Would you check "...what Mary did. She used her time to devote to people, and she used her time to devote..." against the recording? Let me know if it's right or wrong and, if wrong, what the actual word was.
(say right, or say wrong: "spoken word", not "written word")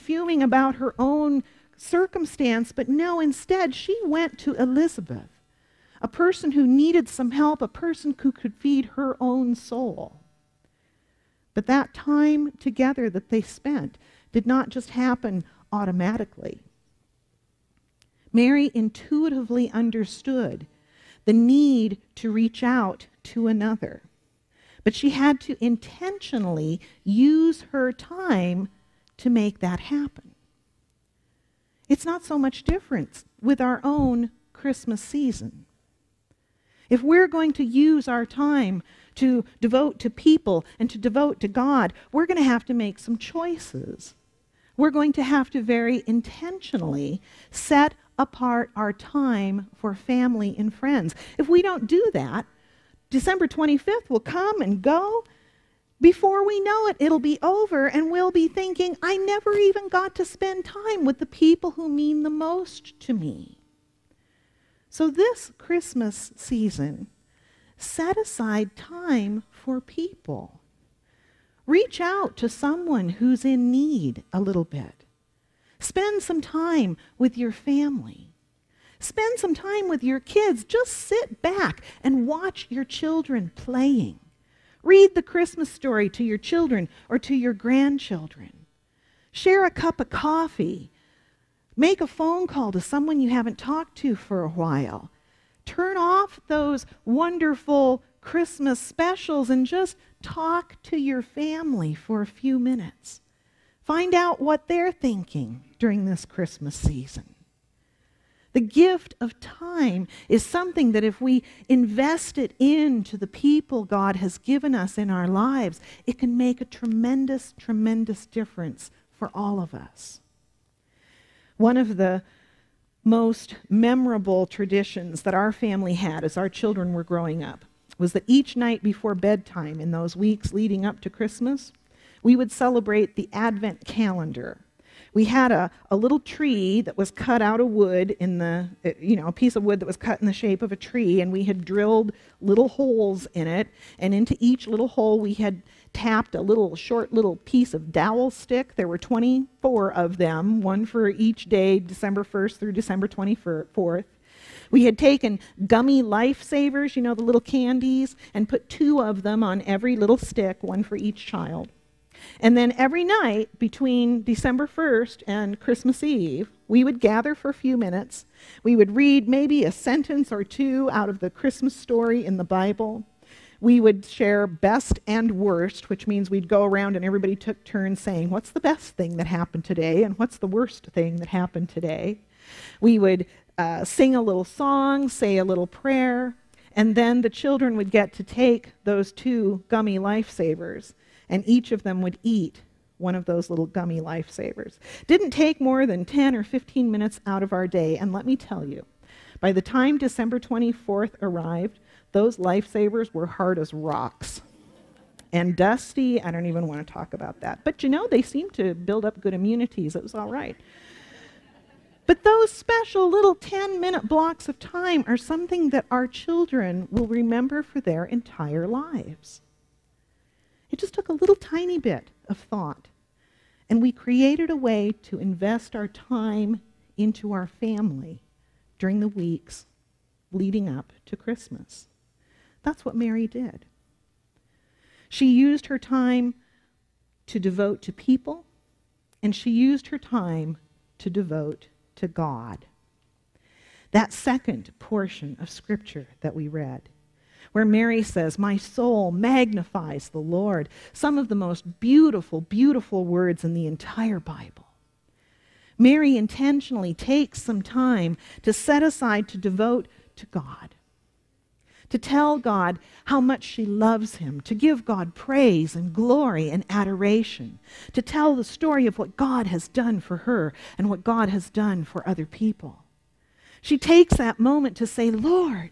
right.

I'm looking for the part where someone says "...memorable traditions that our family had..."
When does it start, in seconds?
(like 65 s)
123 s.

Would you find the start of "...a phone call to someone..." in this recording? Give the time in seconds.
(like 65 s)
91 s.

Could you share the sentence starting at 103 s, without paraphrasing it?
Find out what they're thinking during this Christmas season.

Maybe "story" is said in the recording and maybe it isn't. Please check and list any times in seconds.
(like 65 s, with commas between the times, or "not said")
85 s, 171 s, 268 s.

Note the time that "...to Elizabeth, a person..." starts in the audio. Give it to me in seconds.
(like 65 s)
4 s.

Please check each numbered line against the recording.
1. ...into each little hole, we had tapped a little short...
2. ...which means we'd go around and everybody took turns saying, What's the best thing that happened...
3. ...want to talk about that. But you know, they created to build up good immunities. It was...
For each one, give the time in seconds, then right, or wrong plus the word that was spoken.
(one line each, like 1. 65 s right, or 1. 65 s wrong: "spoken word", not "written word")
1. 144 s right
2. 175 s right
3. 206 s wrong: "seemed", not "created".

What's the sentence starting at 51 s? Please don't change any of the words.
If we don't do that, December 25th will come and go.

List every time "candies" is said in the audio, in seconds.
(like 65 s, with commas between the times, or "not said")
157 s.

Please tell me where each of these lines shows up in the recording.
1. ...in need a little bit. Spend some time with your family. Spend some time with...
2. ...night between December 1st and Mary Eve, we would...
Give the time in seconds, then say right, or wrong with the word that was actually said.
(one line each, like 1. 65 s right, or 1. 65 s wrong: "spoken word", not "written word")
1. 73 s right
2. 163 s wrong: "Christmas", not "Mary".